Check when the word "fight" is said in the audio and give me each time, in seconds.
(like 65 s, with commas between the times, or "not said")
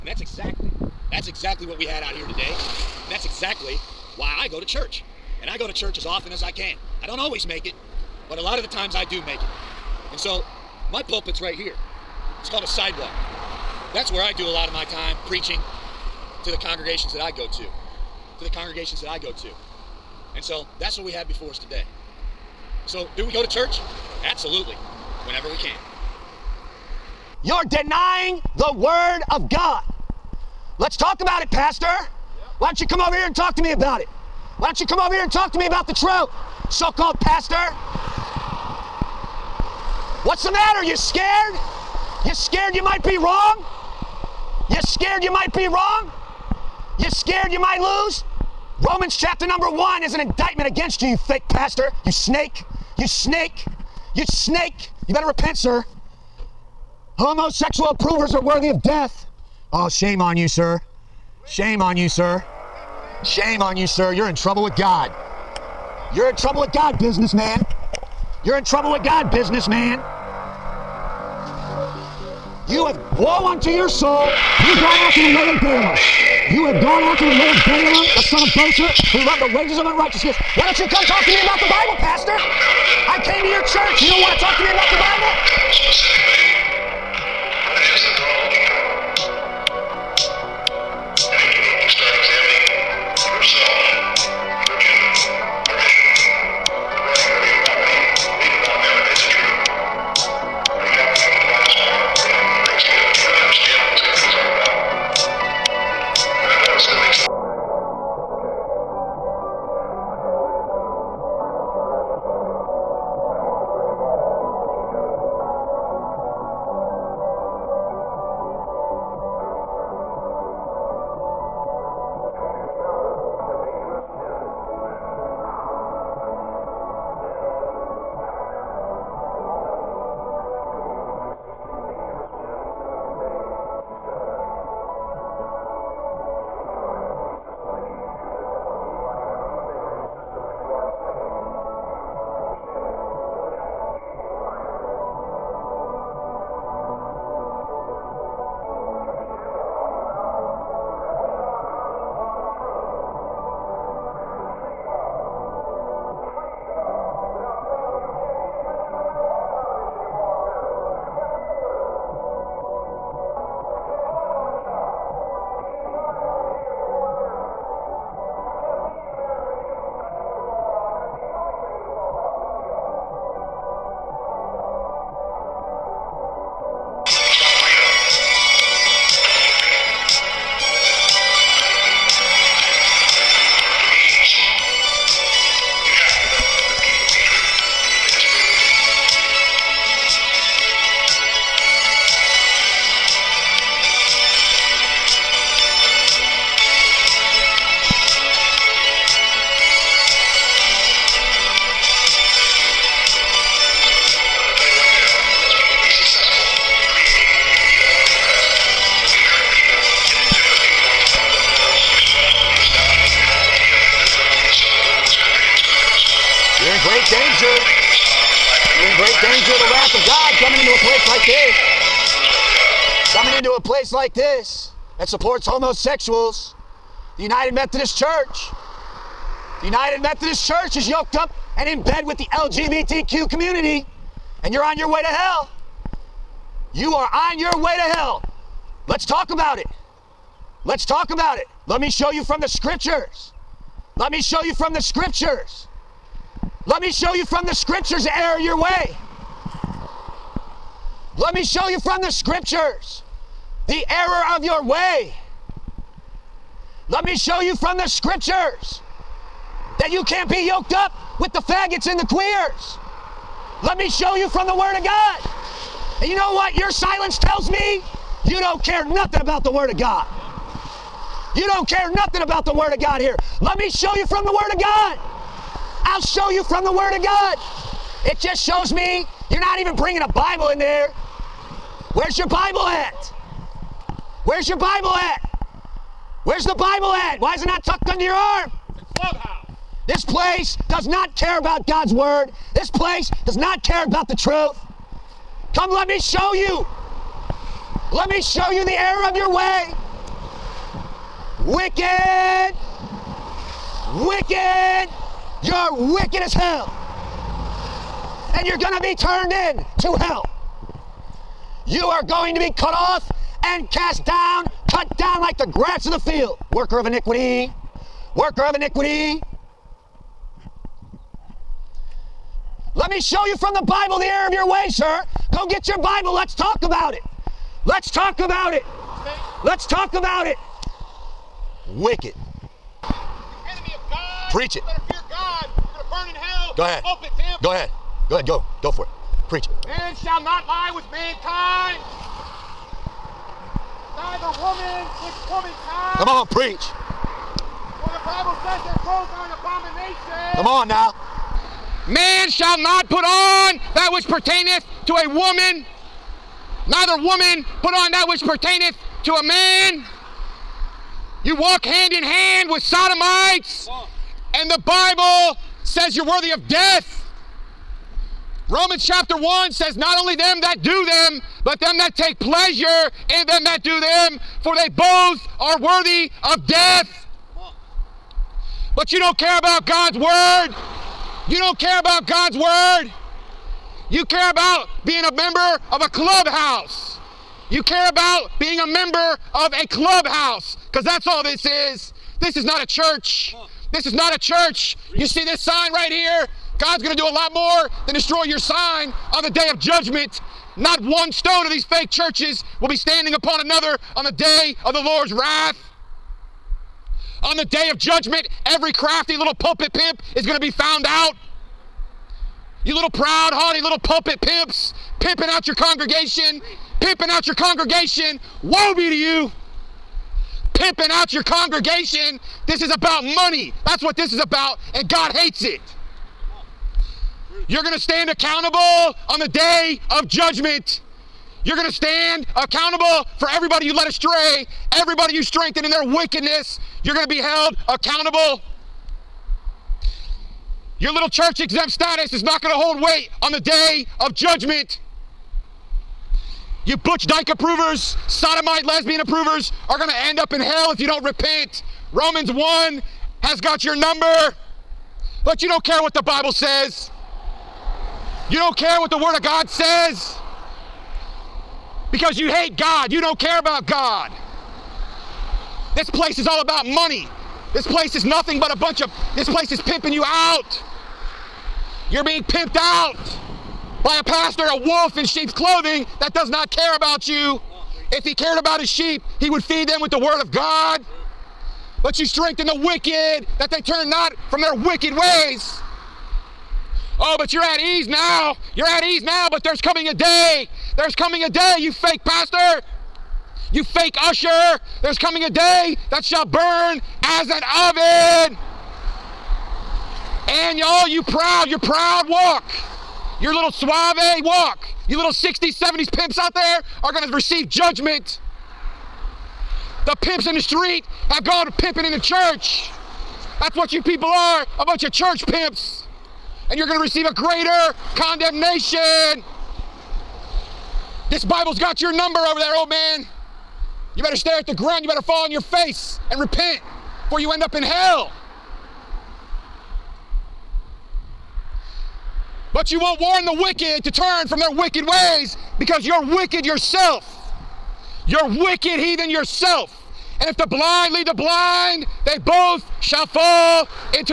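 not said.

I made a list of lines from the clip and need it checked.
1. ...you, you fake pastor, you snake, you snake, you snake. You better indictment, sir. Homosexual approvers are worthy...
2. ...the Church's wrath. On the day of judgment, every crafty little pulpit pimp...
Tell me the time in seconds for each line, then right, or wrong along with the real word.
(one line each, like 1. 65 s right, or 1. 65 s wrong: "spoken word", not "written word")
1. 51 s wrong: "repent", not "indictment"
2. 404 s wrong: "Lord", not "Church".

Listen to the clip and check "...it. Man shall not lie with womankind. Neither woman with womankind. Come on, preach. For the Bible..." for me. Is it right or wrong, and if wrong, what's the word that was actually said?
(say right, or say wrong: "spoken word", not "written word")
wrong: "mankind", not "womankind".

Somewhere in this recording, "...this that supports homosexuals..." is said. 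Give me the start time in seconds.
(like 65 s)
224 s.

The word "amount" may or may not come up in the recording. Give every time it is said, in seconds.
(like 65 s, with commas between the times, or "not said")
not said.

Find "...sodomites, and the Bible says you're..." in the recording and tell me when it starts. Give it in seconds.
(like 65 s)
362 s.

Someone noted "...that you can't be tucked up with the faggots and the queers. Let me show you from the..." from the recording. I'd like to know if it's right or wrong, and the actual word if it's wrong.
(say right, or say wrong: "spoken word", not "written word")
wrong: "yoked", not "tucked".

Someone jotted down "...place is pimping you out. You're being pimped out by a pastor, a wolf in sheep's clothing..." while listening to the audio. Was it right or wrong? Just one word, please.
right.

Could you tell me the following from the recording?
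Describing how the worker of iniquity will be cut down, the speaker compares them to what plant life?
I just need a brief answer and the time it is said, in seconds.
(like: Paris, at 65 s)
Grass of the field, at 315 s.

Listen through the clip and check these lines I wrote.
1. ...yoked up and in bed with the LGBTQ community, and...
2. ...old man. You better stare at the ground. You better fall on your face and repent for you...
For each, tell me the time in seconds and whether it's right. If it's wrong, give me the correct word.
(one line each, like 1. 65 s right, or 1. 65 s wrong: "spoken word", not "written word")
1. 230 s right
2. 522 s right.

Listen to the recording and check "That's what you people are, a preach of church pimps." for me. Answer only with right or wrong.
wrong.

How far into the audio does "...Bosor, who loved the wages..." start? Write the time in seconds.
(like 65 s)
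78 s.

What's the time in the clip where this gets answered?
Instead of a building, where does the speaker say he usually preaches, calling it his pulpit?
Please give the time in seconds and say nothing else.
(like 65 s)
12 s.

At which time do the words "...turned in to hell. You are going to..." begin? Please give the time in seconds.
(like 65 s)
308 s.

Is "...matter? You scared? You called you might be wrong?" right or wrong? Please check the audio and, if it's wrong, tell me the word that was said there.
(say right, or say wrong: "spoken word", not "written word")
wrong: "scared", not "called".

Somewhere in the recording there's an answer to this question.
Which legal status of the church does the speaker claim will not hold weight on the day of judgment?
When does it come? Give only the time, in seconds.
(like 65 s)
441 s.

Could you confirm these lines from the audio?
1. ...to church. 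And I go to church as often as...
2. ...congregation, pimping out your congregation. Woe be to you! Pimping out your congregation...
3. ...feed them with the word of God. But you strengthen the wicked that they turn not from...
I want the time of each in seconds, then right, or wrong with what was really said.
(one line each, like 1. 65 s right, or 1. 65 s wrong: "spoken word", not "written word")
1. 4 s right
2. 415 s right
3. 479 s right.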